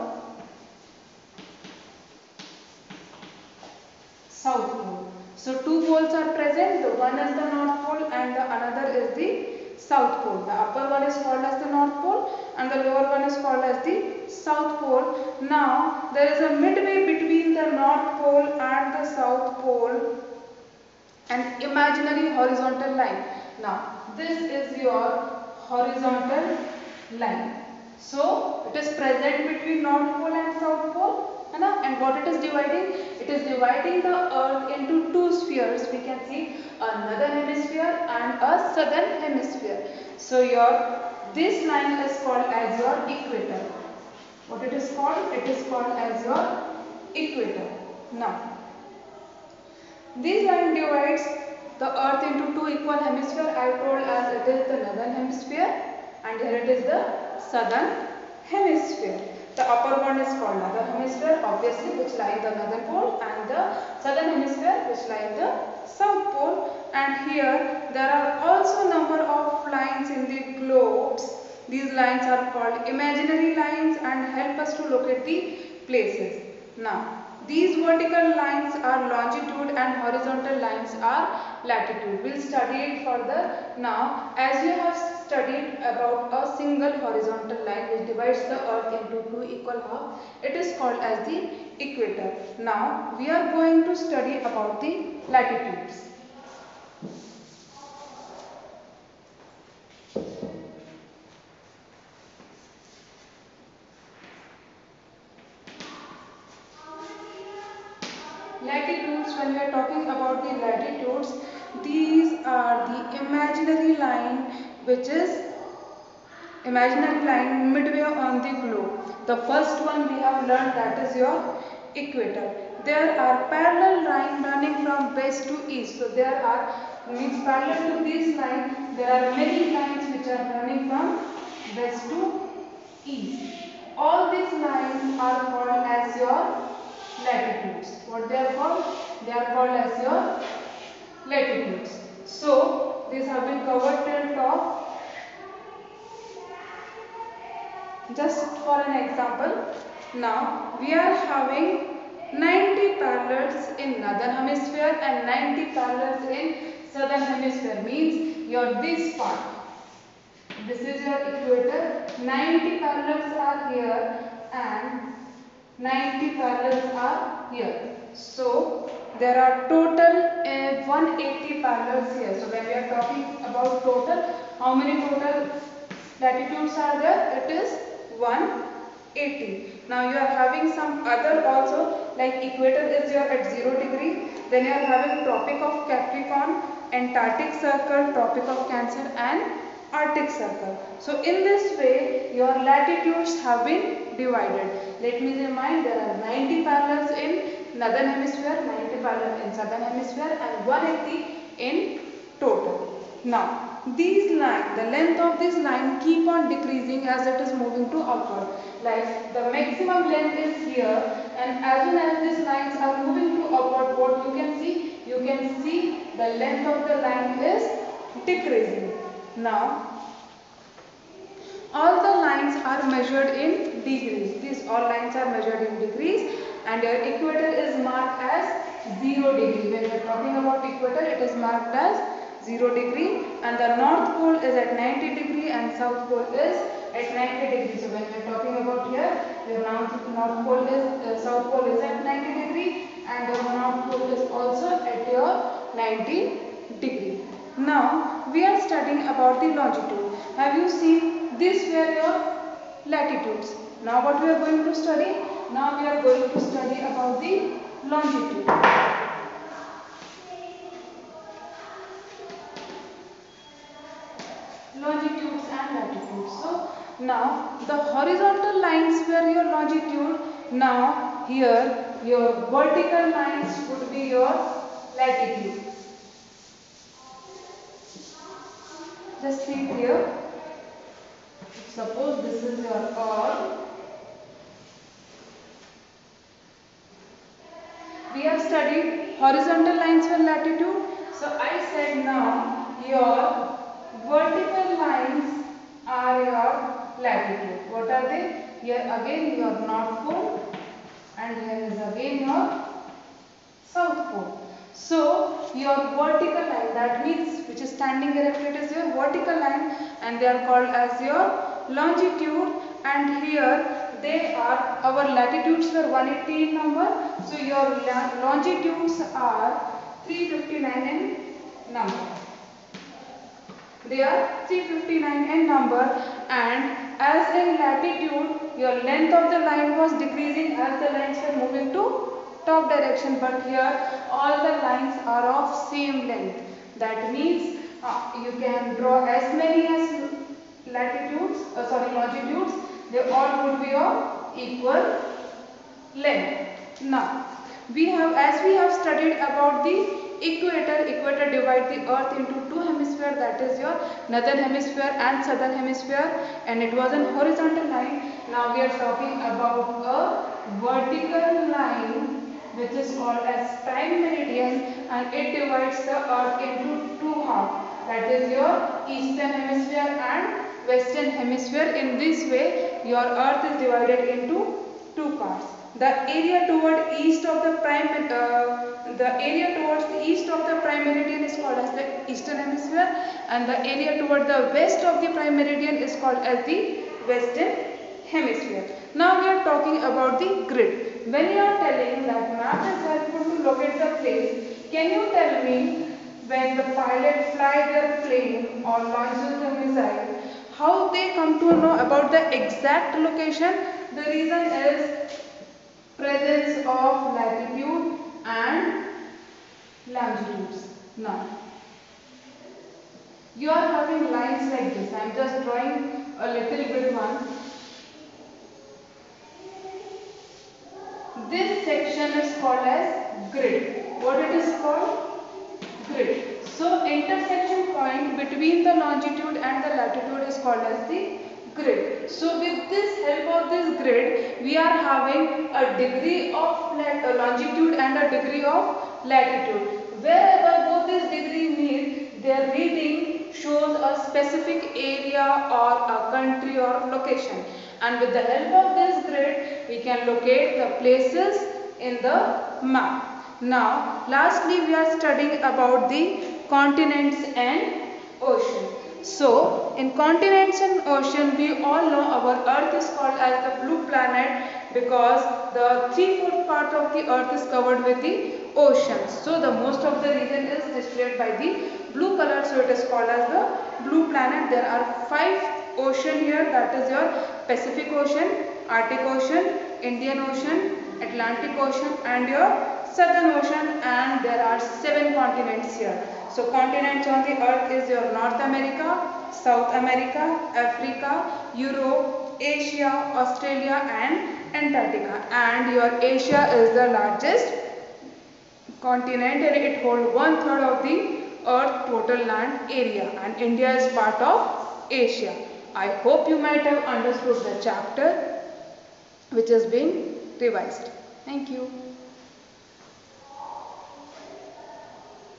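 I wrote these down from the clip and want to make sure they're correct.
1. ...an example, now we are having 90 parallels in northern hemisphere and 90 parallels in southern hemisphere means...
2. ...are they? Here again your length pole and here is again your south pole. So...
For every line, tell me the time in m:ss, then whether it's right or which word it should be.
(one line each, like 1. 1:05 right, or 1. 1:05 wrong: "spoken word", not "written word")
1. 2:28 right
2. 4:57 wrong: "north", not "length".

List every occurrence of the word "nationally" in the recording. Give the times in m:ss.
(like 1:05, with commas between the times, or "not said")
not said.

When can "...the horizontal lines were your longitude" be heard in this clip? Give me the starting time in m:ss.
4:27.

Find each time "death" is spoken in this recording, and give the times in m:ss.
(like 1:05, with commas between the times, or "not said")
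not said.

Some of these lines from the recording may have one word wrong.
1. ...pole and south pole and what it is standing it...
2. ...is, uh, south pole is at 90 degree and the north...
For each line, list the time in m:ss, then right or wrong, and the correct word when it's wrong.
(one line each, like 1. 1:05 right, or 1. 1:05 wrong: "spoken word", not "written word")
1. 0:30 wrong: "dividing", not "standing"
2. 4:00 right.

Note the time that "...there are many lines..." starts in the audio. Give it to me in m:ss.
2:08.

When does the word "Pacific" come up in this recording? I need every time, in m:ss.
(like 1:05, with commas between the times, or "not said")
7:57.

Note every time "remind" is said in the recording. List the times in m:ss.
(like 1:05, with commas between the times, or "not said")
3:15.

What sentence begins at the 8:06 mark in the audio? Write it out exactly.
So continents on the earth is your North America, South America, Africa, Europe, Asia, Australia and Antarctica.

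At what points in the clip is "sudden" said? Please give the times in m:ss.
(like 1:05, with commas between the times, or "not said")
not said.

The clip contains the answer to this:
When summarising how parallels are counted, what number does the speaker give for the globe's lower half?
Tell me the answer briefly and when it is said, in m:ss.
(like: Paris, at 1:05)
95, at 3:18.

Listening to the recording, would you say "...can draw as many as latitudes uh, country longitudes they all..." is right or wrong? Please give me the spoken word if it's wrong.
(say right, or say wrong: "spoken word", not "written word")
wrong: "sorry", not "country".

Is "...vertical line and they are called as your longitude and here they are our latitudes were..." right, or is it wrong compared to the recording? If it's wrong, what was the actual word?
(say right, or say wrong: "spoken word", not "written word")
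right.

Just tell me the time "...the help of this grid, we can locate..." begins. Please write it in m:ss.
7:28.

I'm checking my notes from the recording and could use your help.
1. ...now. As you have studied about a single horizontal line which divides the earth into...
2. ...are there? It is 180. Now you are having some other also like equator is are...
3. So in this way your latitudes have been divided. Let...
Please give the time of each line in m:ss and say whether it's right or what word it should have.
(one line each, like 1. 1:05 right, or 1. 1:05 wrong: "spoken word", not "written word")
1. 1:23 right
2. 2:56 right
3. 3:10 right.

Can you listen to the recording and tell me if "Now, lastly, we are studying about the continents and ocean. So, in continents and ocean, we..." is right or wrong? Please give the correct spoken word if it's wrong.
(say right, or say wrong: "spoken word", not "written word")
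right.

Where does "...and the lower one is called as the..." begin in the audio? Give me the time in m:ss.
0:12.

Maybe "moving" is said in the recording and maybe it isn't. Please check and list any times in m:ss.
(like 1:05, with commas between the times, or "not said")
3:27, 3:33, 5:31.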